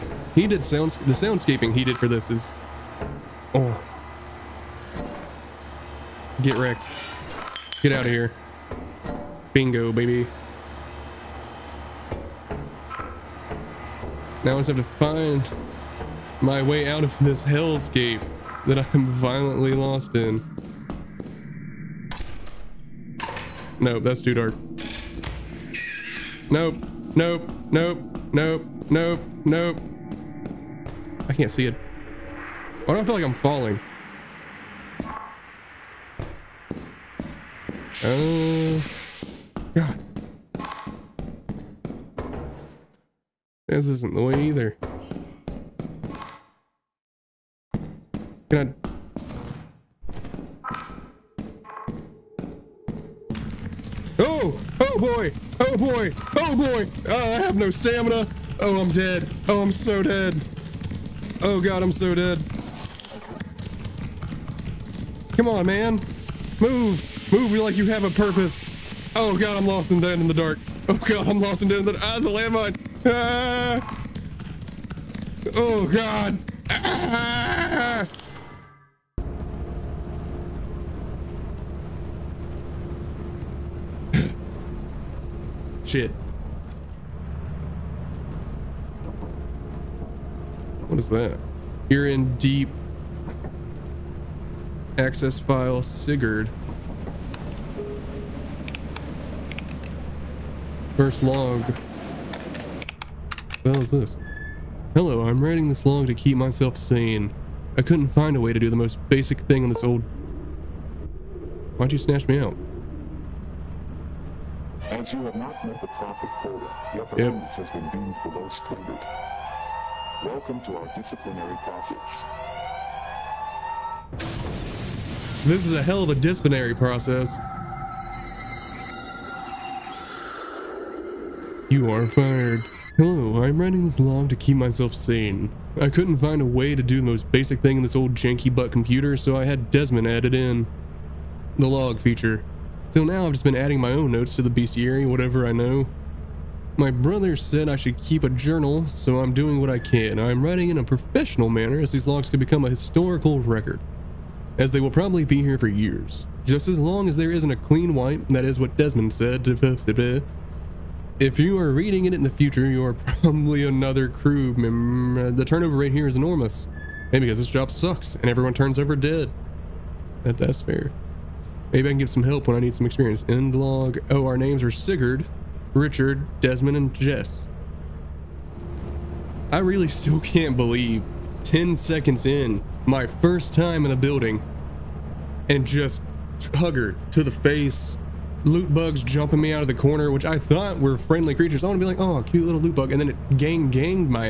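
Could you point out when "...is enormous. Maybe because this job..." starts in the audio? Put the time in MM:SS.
02:46.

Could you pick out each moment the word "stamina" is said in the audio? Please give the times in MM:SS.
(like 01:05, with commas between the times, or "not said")
00:57.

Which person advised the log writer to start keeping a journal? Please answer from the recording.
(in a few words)
My brother.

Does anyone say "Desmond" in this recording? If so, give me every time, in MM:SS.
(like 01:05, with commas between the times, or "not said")
02:19, 02:38, 02:56.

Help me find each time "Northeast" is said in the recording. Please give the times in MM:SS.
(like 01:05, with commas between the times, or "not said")
not said.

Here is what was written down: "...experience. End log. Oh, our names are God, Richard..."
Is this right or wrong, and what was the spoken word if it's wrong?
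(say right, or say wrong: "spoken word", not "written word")
wrong: "Sigurd", not "God".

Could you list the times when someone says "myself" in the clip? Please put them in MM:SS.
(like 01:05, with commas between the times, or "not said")
01:46, 02:14.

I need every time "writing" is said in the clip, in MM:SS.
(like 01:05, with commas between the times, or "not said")
01:45, 02:13, 02:30.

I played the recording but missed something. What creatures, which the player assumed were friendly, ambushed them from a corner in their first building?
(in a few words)
Loot bugs.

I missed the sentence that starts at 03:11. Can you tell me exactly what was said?
I want to be like, oh, cute little loot bug.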